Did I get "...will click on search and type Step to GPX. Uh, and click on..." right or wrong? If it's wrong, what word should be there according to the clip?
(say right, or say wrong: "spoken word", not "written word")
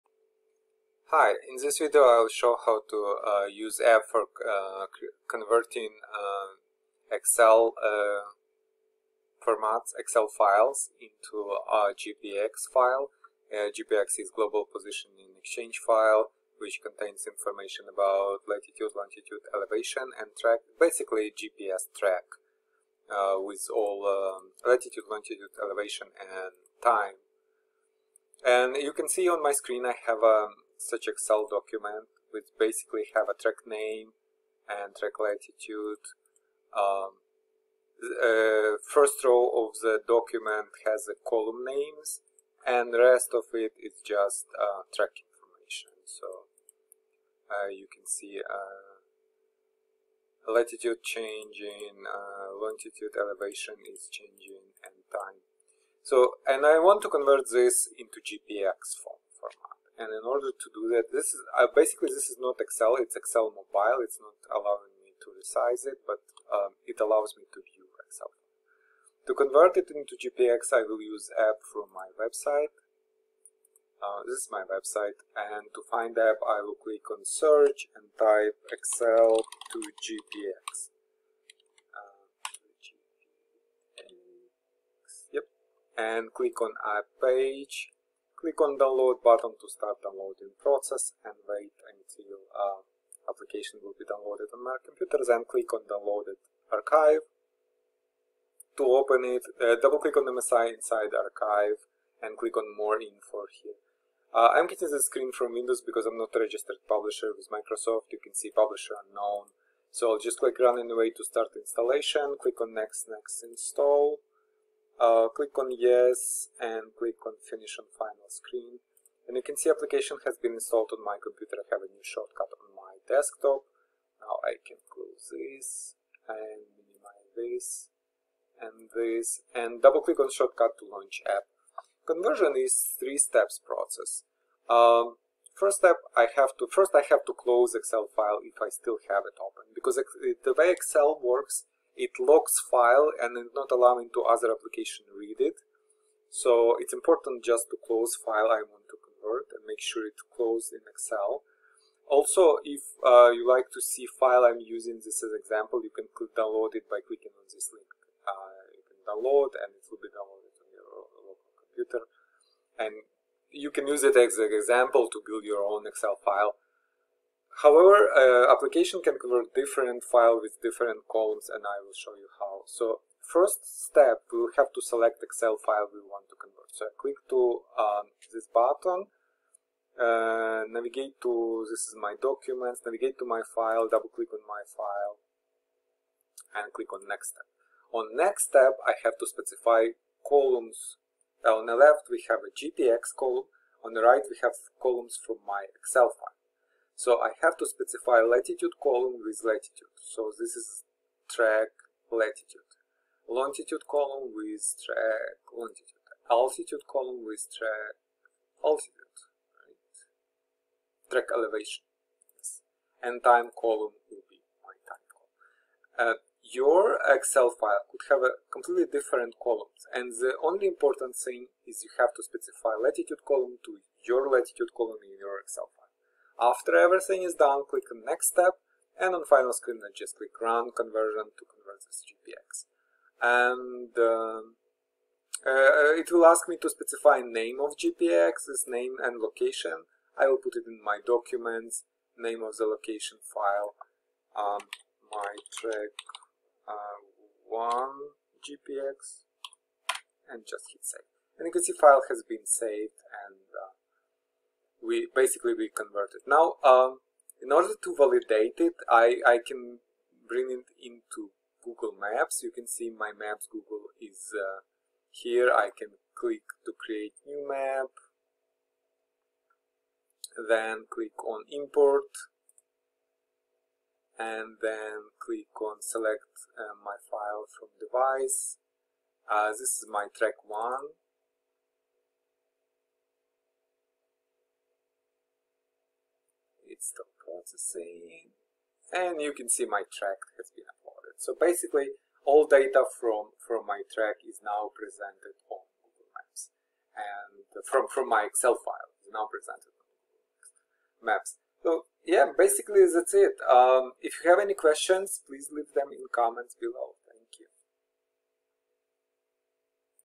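wrong: "Excel", not "Step".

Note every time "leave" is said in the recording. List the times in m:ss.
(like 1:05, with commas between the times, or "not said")
5:05.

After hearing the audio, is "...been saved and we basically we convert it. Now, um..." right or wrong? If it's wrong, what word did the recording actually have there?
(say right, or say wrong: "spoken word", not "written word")
right.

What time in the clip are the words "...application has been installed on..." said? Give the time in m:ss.
1:59.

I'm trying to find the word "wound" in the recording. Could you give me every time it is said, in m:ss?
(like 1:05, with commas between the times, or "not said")
not said.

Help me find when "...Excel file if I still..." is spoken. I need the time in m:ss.
2:17.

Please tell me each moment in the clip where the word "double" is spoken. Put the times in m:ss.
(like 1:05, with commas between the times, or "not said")
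1:39, 2:09, 3:03.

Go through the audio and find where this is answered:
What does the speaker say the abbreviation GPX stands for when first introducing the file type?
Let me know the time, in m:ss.
0:14.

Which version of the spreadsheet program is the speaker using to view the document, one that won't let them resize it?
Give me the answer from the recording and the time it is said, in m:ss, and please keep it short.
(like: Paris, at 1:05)
Excel mobile, at 1:03.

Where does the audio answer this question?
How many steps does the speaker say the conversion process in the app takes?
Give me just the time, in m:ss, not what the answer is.
2:12.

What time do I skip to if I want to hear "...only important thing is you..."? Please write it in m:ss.
3:40.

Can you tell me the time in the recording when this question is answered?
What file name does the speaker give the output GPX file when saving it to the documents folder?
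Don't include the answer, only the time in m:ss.
4:05.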